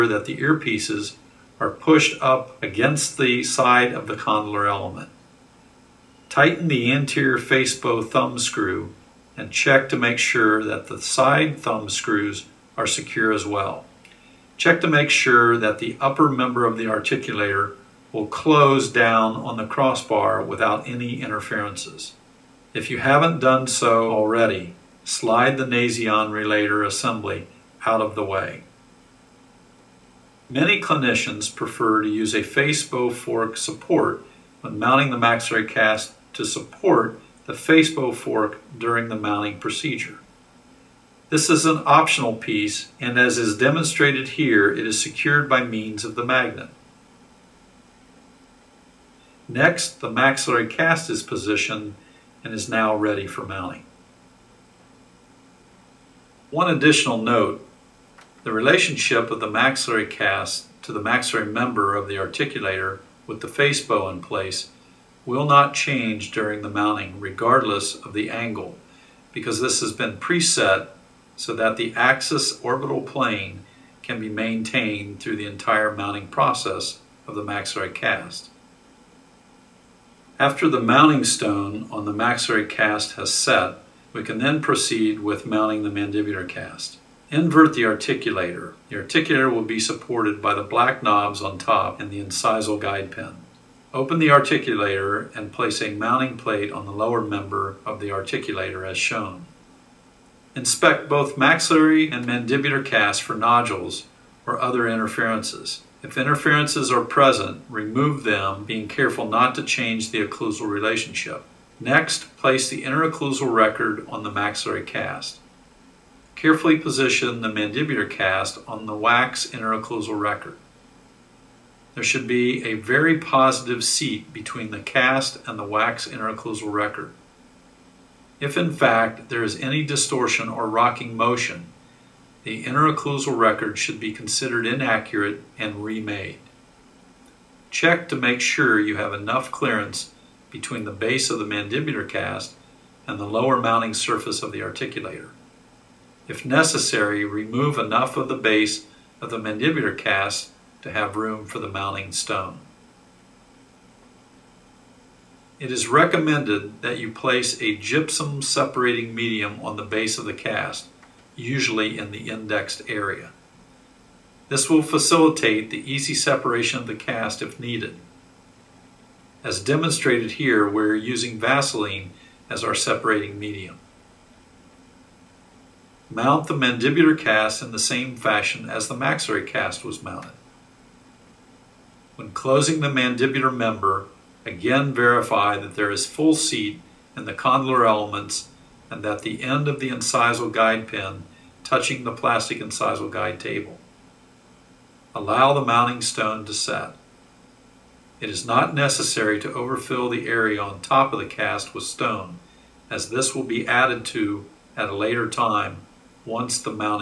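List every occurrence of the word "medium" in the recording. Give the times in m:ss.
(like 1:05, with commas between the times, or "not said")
2:39, 2:53.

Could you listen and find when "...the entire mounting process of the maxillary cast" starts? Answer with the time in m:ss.
1:15.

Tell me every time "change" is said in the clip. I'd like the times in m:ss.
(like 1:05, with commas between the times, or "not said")
1:05, 1:49.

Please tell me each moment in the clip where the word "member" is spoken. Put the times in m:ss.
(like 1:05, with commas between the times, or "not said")
0:16, 1:01, 1:37, 3:03.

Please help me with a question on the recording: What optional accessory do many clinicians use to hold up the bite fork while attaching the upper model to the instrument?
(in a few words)
face bow fork support.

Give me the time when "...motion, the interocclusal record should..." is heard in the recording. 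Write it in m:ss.
2:11.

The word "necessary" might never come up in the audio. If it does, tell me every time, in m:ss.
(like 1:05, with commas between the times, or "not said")
2:26, 3:18.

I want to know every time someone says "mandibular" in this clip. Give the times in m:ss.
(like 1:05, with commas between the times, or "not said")
1:25, 1:42, 1:57, 2:21, 2:29, 2:56, 3:02.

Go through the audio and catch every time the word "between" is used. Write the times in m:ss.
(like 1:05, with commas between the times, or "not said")
2:04, 2:20.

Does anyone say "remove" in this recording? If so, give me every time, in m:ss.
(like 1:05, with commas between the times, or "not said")
1:47, 2:27.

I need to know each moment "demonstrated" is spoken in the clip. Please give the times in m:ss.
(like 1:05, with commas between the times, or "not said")
0:43, 2:49.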